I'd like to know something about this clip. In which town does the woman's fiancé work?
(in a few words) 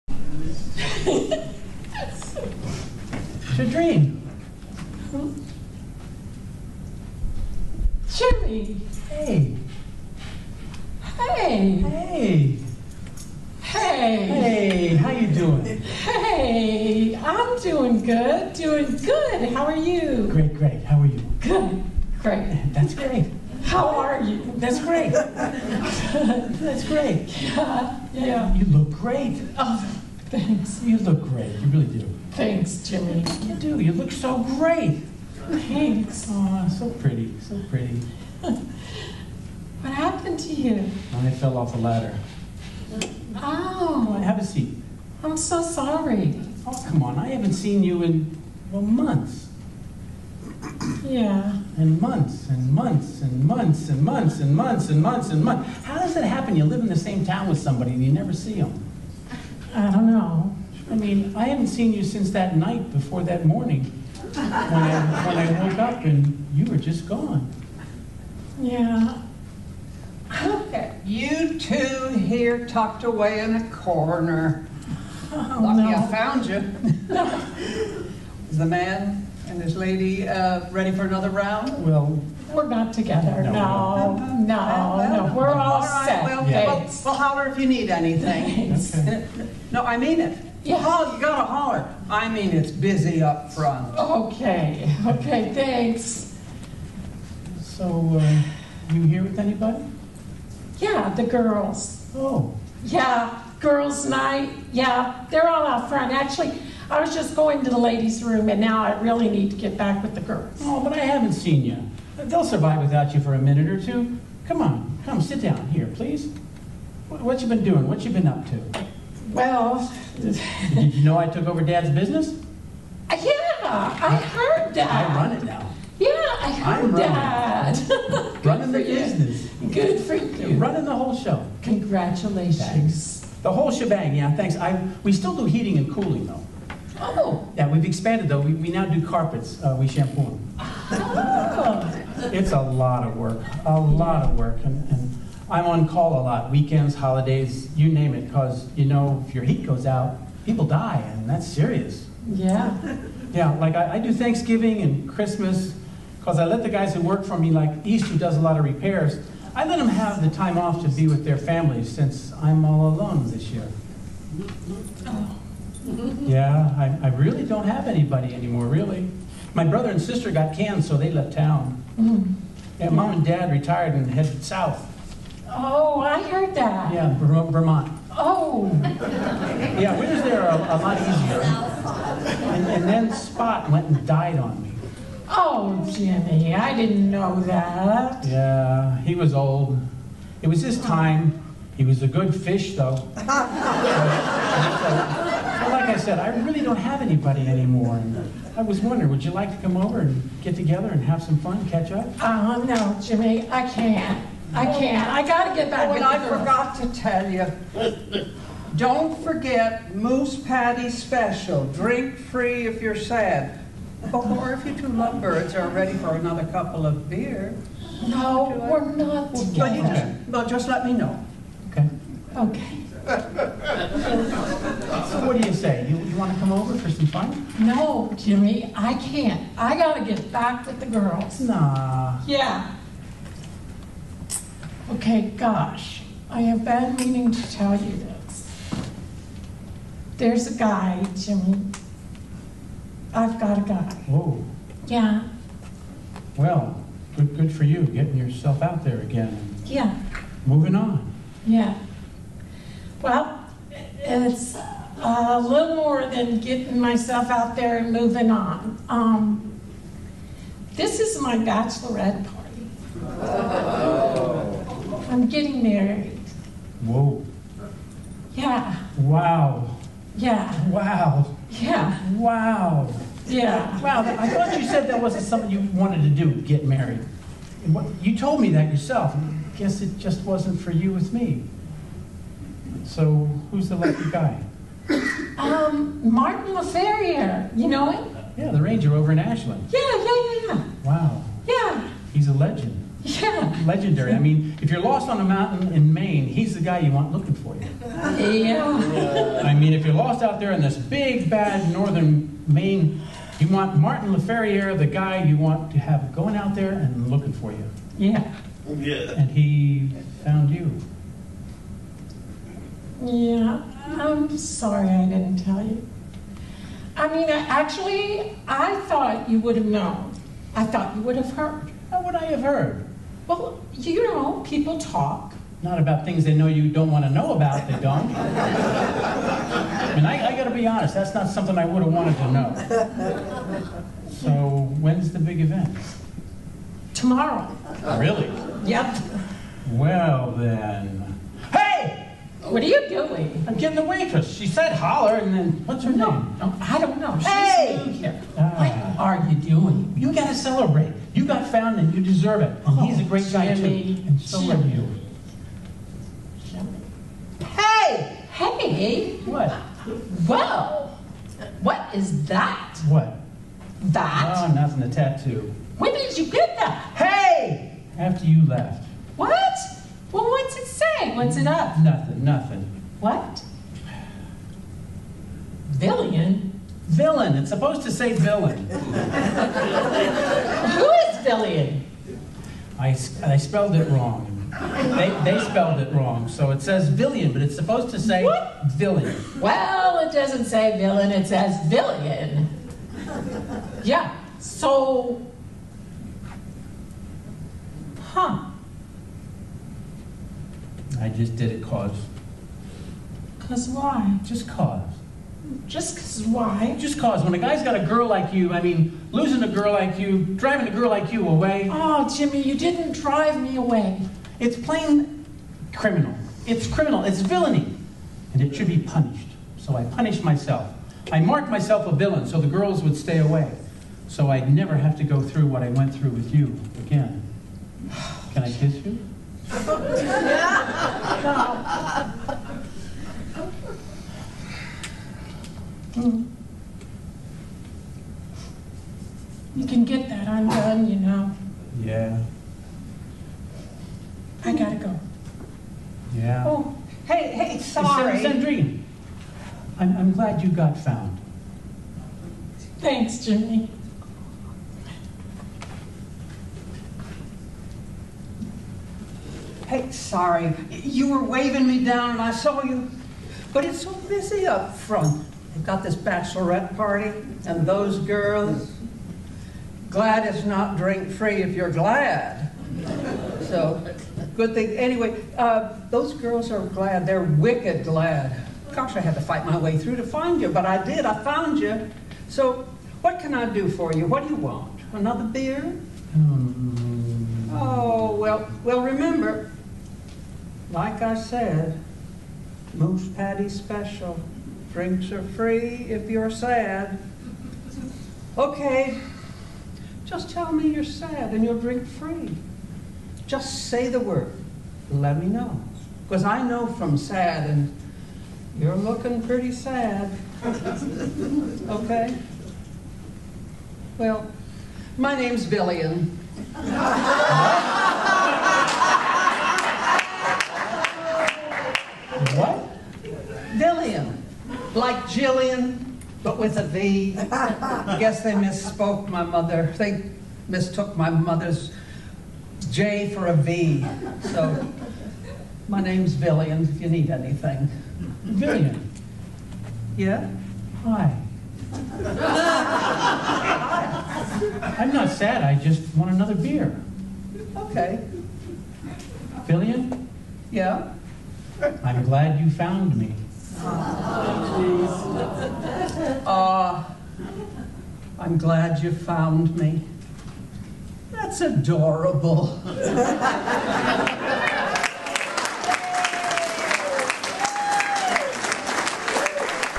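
Ashland.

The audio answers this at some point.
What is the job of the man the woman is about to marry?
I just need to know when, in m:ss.
4:48.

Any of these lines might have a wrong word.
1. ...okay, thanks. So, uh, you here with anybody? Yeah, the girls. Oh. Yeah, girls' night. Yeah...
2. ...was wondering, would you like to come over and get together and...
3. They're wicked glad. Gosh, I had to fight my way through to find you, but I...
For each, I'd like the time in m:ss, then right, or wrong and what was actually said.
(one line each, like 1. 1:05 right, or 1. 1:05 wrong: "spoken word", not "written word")
1. 1:35 right
2. 3:18 right
3. 7:57 right.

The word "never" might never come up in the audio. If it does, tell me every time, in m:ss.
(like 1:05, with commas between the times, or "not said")
0:58, 7:04.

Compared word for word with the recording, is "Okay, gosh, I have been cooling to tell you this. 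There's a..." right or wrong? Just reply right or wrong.
wrong.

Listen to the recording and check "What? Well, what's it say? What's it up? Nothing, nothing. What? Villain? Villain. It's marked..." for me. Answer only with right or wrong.
wrong.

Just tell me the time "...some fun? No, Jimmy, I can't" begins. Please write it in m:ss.
3:46.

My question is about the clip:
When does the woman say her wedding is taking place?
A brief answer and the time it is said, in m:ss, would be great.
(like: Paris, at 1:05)
Tomorrow, at 5:36.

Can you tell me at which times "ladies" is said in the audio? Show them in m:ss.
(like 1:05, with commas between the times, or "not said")
1:47.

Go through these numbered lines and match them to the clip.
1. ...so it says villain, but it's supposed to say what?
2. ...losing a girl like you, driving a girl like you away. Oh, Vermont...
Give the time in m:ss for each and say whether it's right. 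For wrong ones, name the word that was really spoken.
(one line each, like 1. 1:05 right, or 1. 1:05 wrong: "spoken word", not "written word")
1. 6:26 right
2. 6:49 wrong: "Jimmy", not "Vermont".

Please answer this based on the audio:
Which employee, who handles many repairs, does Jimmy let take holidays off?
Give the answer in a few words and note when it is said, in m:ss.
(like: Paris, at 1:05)
East, at 2:37.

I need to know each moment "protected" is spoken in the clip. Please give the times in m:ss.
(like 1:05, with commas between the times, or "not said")
not said.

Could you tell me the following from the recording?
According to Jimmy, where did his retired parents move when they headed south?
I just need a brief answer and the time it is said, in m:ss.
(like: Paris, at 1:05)
Vermont, at 2:57.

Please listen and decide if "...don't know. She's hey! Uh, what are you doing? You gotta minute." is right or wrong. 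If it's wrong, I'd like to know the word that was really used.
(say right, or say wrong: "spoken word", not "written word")
wrong: "celebrate", not "minute".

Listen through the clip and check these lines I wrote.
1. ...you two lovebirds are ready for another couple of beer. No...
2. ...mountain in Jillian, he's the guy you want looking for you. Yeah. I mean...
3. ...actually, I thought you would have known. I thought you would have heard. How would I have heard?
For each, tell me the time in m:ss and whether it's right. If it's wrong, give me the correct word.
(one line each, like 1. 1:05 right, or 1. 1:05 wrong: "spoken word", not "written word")
1. 3:34 right
2. 4:55 wrong: "Maine", not "Jillian"
3. 5:17 right.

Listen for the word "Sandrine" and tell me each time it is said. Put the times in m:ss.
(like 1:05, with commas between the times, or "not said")
7:28.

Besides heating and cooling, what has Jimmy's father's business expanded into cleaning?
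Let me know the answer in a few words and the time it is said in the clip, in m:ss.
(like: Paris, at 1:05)
Carpets, at 2:19.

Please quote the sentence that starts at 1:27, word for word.
Well, will holler if you need anything.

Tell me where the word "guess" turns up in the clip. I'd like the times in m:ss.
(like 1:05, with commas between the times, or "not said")
4:39, 8:47.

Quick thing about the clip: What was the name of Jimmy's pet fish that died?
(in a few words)
Spot.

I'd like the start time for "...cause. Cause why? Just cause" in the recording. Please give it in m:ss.
6:41.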